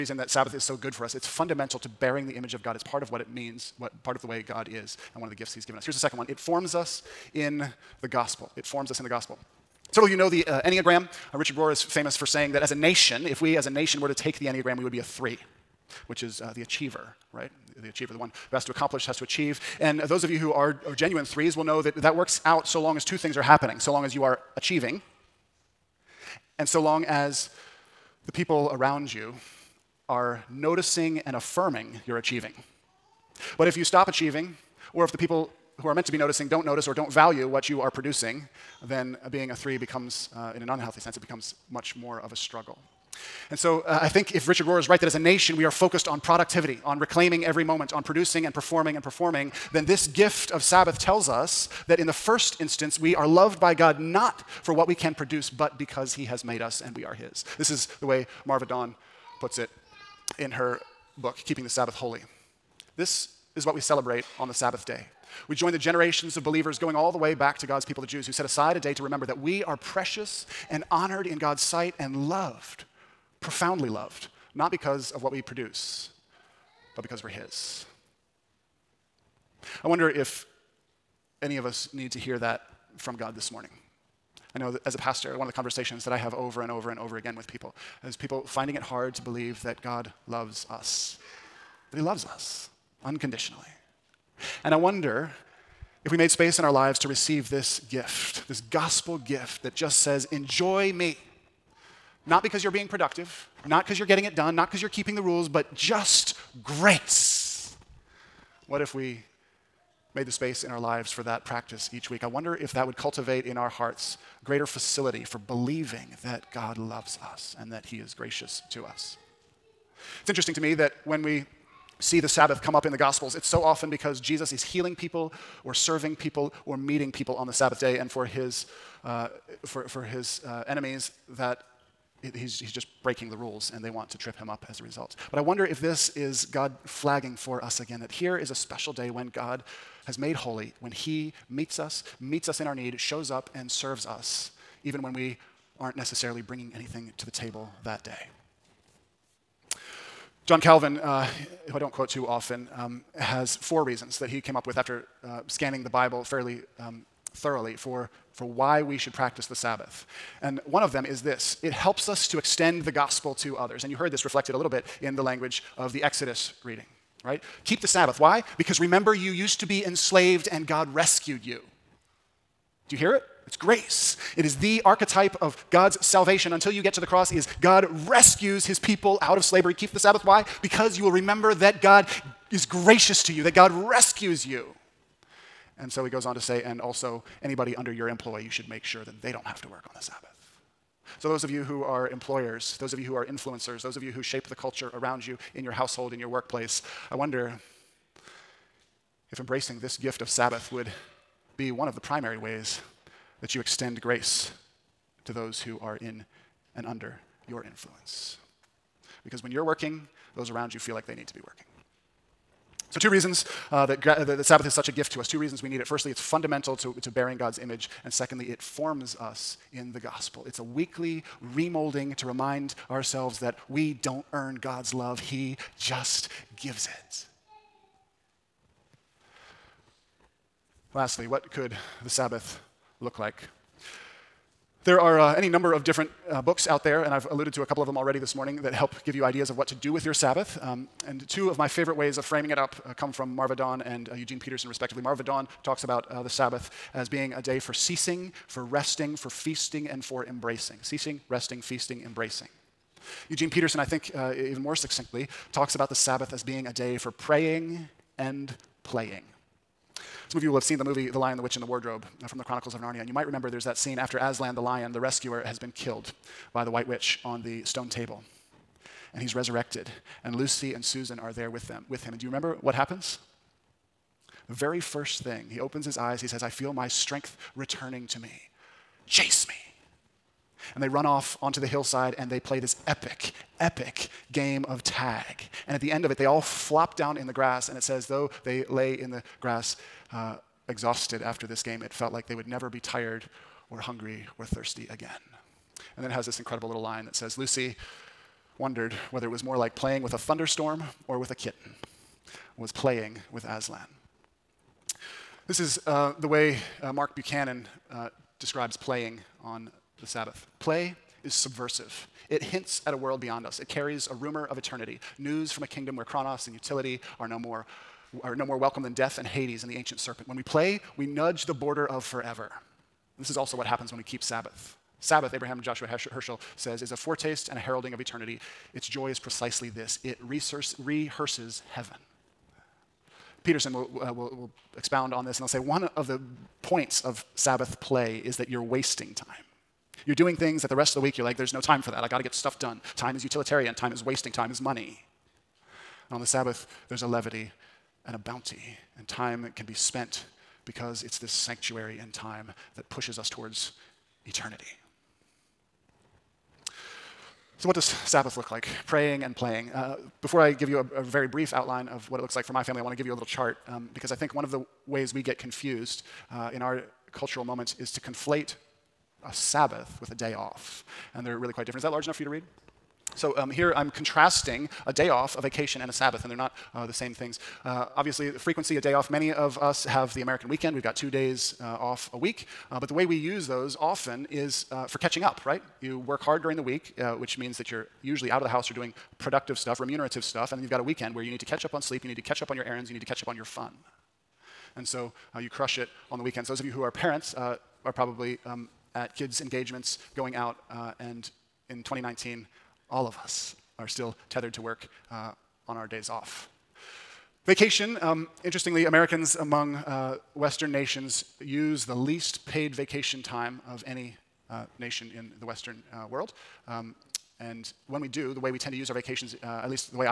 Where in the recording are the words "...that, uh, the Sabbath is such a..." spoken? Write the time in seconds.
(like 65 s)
213 s.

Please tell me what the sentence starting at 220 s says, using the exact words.
It's a weekly remolding to remind ourselves that we don't earn God's love, He just gives it.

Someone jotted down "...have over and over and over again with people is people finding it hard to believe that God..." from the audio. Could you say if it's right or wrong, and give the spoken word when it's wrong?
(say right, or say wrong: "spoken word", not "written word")
right.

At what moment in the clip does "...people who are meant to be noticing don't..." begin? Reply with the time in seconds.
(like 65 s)
35 s.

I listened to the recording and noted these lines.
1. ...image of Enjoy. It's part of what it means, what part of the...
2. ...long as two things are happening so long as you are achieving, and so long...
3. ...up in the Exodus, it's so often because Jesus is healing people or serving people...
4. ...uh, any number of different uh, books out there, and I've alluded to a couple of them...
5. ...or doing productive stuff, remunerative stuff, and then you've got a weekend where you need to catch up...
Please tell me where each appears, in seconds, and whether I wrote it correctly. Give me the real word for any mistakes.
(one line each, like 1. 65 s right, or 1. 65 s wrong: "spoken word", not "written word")
1. 2 s wrong: "God", not "Enjoy"
2. 22 s right
3. 122 s wrong: "Gospels", not "Exodus"
4. 235 s right
5. 388 s right.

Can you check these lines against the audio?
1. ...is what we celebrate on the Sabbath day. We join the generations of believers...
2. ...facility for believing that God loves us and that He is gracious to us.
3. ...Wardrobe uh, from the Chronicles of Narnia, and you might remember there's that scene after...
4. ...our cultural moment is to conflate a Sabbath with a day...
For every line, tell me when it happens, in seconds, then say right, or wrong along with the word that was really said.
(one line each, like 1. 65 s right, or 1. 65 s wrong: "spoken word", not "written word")
1. 63 s right
2. 114 s right
3. 261 s right
4. 366 s right.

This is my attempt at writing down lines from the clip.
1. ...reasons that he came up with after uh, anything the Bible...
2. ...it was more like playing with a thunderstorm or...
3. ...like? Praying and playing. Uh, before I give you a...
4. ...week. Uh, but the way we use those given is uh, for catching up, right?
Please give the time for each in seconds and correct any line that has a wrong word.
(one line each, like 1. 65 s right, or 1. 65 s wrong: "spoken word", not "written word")
1. 153 s wrong: "scanning", not "anything"
2. 299 s right
3. 358 s right
4. 382 s wrong: "often", not "given".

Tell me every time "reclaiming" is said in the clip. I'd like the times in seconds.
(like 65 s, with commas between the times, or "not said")
46 s.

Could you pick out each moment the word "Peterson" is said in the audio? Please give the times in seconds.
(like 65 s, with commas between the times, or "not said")
244 s, 253 s, 333 s.